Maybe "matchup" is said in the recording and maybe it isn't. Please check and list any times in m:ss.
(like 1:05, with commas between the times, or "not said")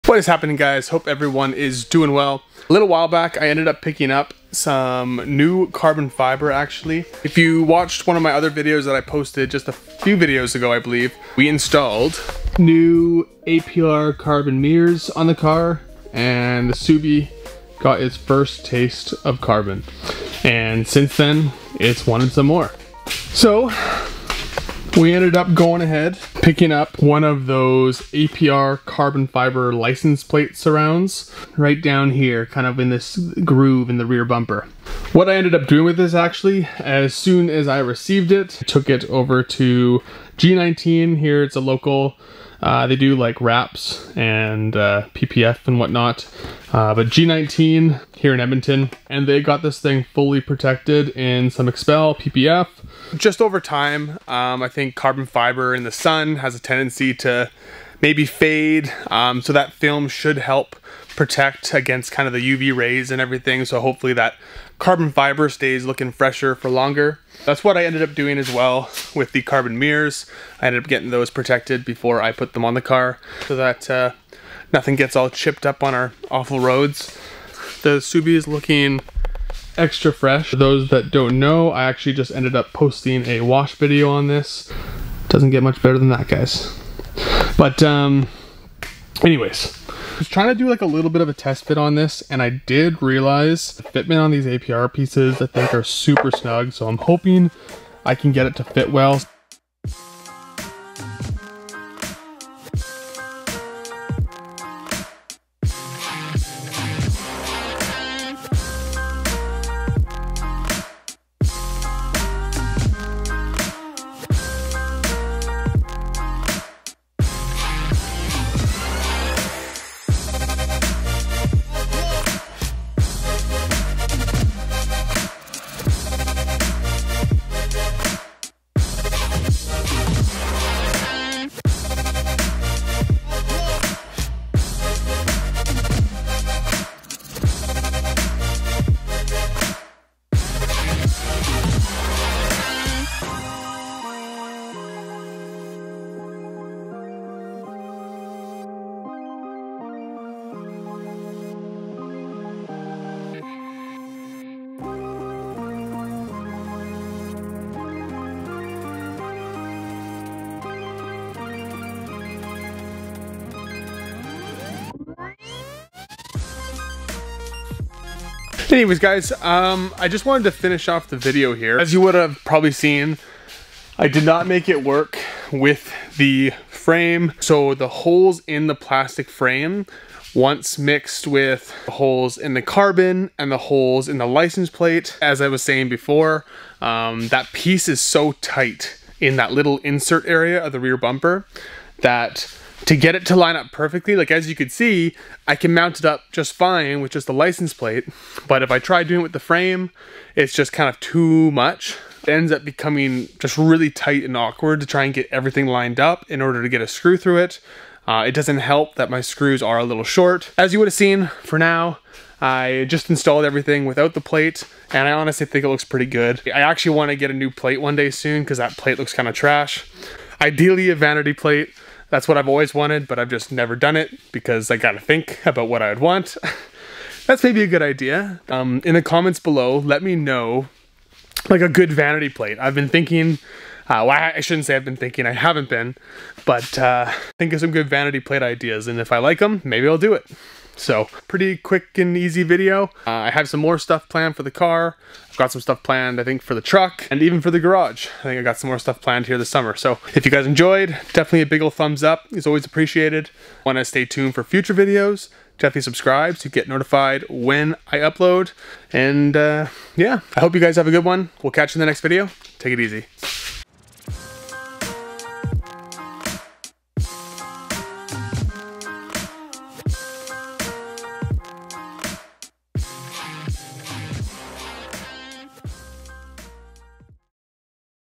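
not said.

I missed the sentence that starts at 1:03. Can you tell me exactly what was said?
So hopefully that carbon fiber stays looking fresher for longer.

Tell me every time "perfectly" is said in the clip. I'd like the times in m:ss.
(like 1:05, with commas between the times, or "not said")
3:13.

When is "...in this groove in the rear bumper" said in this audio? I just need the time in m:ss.
0:32.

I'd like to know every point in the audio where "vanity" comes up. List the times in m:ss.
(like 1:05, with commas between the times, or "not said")
3:40, 3:51, 3:57.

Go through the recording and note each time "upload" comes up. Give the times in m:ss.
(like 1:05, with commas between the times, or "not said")
4:17.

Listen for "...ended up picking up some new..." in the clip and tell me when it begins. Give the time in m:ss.
0:03.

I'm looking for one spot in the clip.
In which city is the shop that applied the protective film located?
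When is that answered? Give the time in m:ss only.
0:48.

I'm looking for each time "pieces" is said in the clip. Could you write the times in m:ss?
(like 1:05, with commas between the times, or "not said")
1:34, 3:07.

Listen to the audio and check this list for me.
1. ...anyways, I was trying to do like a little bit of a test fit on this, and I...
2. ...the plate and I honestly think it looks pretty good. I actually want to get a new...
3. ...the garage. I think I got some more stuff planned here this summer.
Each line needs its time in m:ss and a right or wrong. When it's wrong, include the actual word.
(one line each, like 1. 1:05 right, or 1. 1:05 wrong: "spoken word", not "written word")
1. 1:29 right
2. 3:34 right
3. 4:07 right.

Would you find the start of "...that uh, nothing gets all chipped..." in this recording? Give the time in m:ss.
1:13.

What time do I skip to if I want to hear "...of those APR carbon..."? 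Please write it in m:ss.
0:27.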